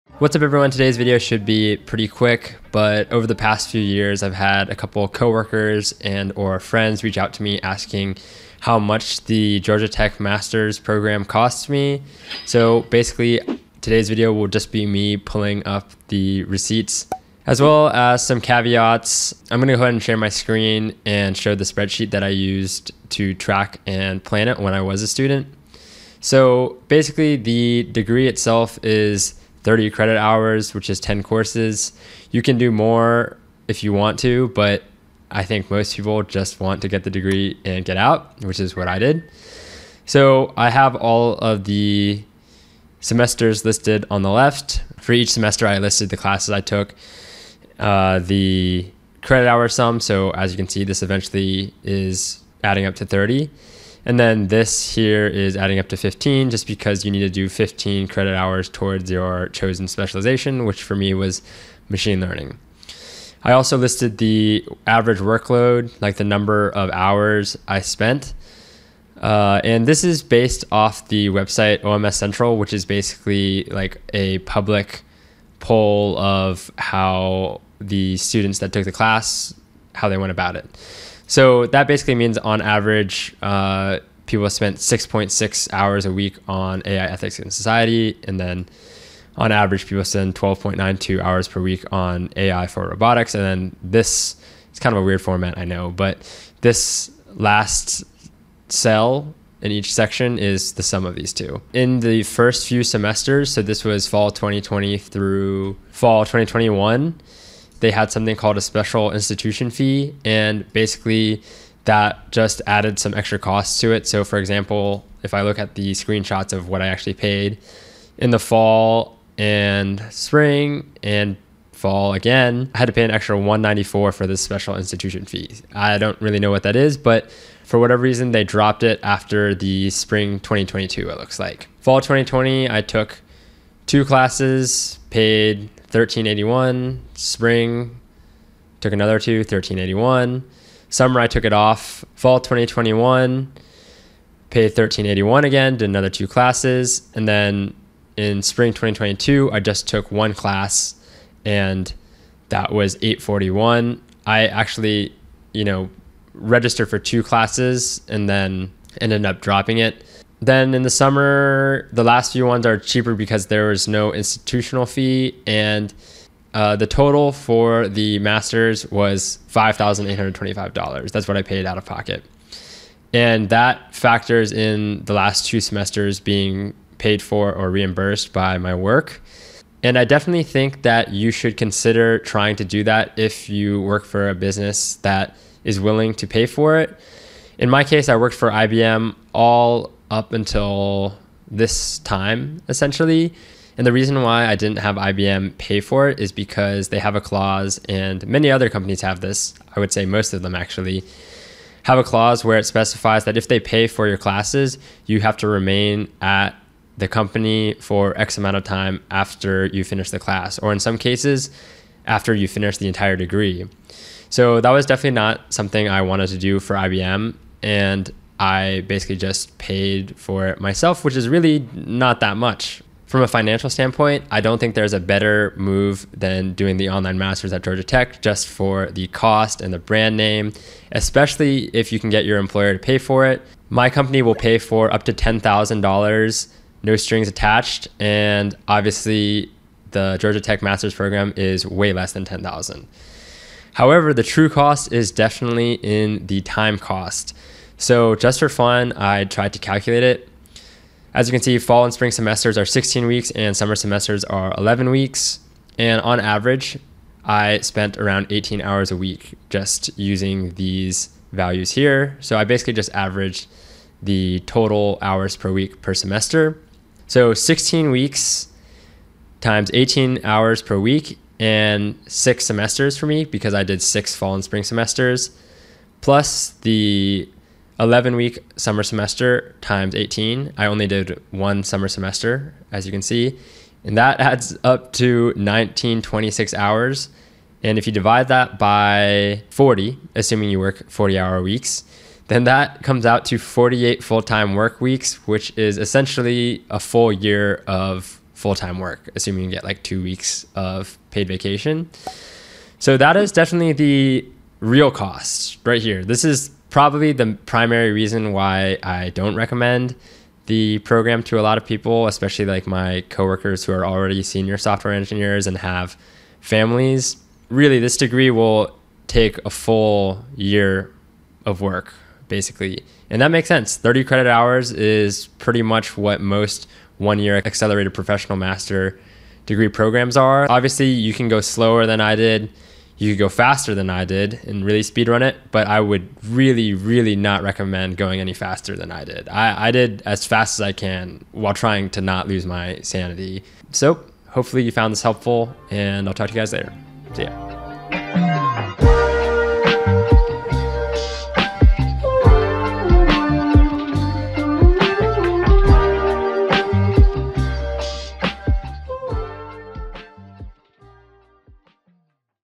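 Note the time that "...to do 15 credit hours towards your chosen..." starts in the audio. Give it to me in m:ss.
0:57.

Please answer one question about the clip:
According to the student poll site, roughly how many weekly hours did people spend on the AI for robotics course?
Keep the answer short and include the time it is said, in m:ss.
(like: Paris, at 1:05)
12.92, at 1:30.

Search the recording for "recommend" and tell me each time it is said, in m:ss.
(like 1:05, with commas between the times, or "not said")
5:09, 5:37.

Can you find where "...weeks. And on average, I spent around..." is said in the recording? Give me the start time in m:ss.
4:14.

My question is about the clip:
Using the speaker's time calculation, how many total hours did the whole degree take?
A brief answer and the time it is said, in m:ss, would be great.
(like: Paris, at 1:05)
1926, at 4:45.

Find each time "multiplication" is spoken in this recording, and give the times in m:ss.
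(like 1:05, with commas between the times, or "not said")
not said.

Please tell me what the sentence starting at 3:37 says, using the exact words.
And I basically just paid for it myself, which is really not that much.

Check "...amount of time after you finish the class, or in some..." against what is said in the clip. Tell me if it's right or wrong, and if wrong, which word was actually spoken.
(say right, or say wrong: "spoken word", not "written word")
right.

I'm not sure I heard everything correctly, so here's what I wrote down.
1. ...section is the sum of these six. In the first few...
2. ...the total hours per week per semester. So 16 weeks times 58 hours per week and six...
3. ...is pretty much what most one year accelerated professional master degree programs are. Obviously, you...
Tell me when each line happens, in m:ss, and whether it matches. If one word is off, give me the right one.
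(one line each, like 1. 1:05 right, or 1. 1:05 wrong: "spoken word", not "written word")
1. 1:39 wrong: "two", not "six"
2. 4:23 wrong: "18", not "58"
3. 5:24 right.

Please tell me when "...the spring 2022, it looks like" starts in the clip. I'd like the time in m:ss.
2:09.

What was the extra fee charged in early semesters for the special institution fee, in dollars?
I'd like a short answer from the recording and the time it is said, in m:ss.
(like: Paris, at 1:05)
194, at 2:03.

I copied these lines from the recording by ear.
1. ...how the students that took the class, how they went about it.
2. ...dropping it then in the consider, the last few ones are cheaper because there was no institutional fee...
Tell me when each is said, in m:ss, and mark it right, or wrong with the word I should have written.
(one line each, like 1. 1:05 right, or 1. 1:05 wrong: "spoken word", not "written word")
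1. 1:16 right
2. 2:39 wrong: "summer", not "consider".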